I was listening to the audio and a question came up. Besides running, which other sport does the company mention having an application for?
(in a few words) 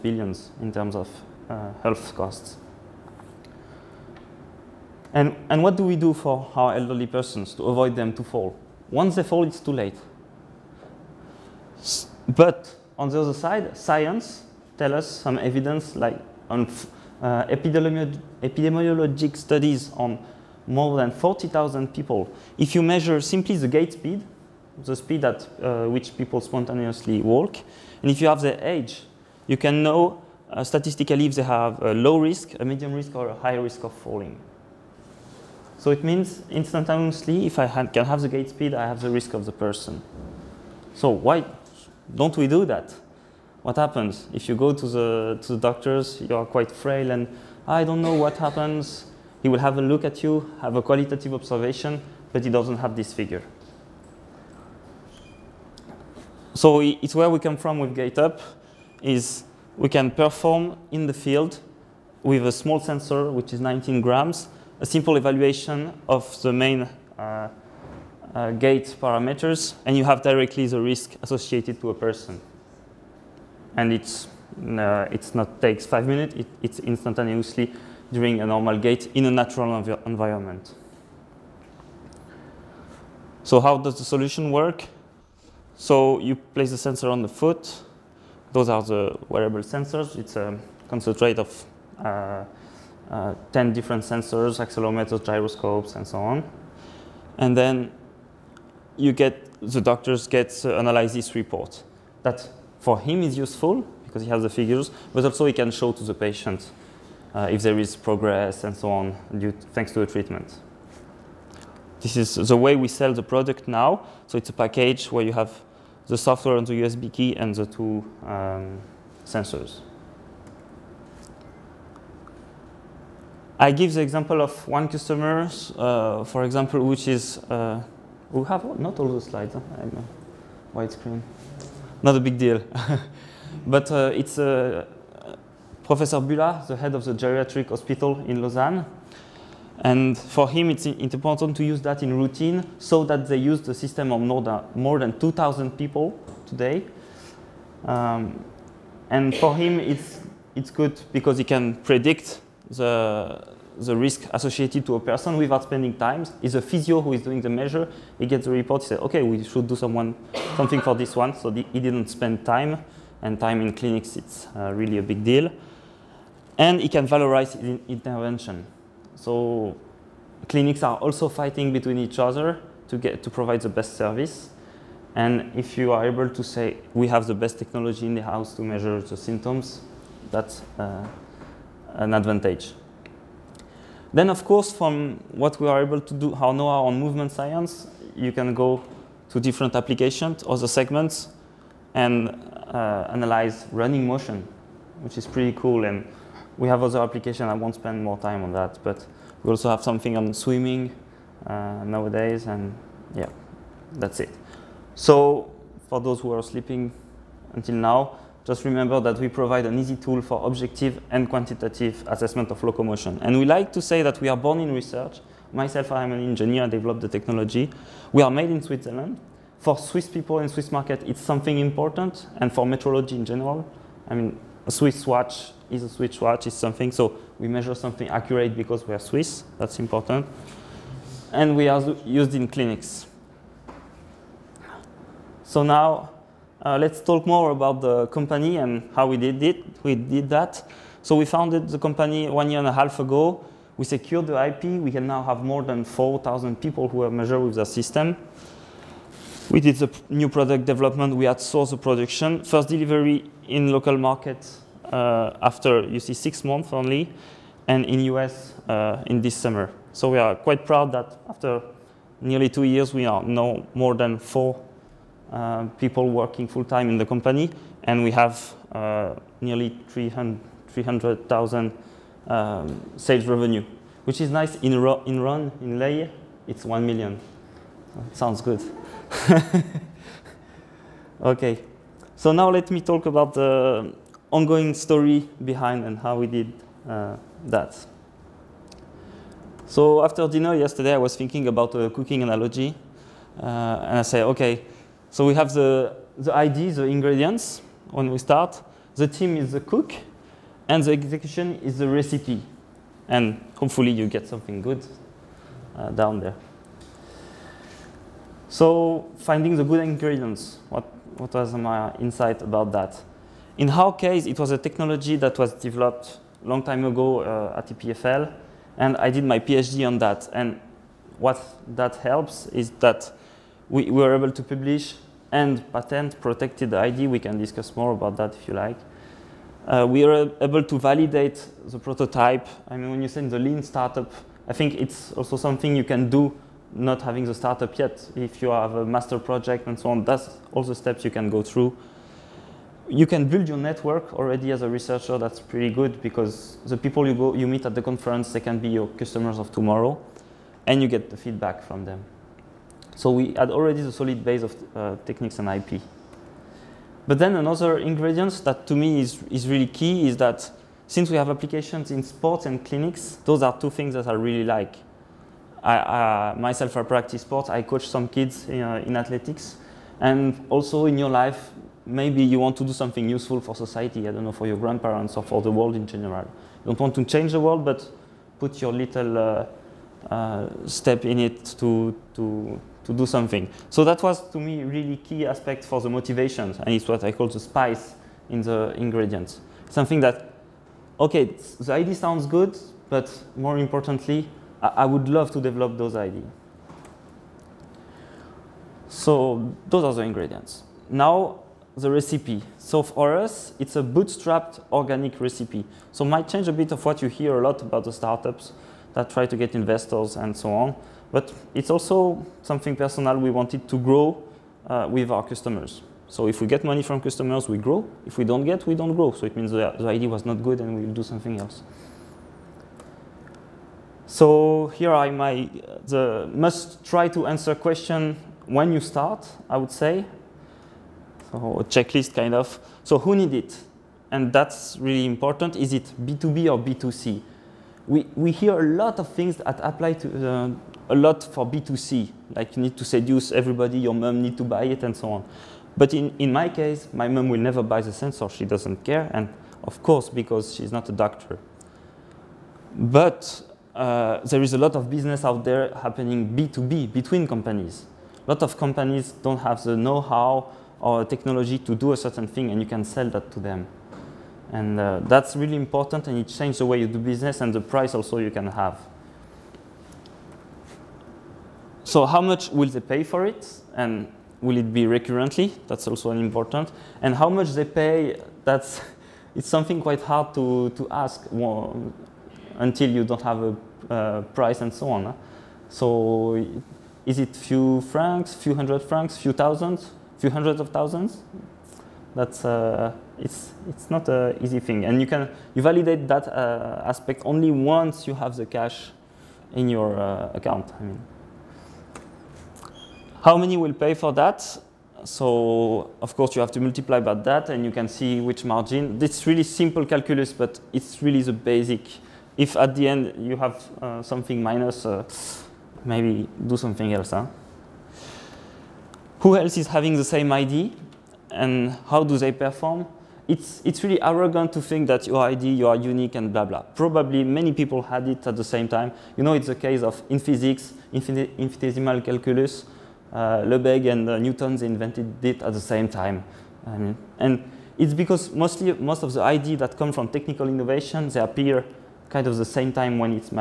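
Swimming.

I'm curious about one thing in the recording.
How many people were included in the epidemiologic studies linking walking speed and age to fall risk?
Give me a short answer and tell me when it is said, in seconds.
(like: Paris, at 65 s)
40,000, at 21 s.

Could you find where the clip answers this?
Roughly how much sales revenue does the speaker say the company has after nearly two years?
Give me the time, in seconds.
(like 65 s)
269 s.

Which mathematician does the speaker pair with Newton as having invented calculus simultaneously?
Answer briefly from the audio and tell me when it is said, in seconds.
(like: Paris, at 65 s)
Lebesgue, at 533 s.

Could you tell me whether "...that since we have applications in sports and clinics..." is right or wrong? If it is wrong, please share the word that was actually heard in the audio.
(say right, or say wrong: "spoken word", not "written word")
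right.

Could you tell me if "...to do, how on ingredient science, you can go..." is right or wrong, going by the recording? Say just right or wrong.
wrong.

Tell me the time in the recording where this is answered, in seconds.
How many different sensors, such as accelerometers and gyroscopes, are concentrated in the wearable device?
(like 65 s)
93 s.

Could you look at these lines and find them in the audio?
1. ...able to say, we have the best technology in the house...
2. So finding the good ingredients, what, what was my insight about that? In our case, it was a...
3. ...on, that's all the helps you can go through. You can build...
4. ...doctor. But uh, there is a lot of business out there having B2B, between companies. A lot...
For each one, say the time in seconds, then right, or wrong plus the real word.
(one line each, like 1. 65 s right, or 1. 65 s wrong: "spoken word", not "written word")
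1. 176 s right
2. 308 s right
3. 339 s wrong: "steps", not "helps"
4. 450 s wrong: "happening", not "having".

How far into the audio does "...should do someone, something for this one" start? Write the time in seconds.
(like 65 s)
159 s.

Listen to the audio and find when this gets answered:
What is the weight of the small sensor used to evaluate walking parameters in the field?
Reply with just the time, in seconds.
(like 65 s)
63 s.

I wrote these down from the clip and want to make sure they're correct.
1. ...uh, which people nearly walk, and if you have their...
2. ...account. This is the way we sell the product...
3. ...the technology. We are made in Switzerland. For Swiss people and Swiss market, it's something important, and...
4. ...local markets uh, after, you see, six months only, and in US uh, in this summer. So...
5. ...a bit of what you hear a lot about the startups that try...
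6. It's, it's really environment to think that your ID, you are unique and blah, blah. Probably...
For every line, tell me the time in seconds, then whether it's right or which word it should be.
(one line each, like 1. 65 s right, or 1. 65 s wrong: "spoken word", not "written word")
1. 25 s wrong: "spontaneously", not "nearly"
2. 110 s wrong: "treatment", not "account"
3. 217 s right
4. 253 s right
5. 406 s right
6. 523 s wrong: "arrogant", not "environment".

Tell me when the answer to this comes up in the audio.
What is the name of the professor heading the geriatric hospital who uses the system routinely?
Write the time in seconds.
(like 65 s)
135 s.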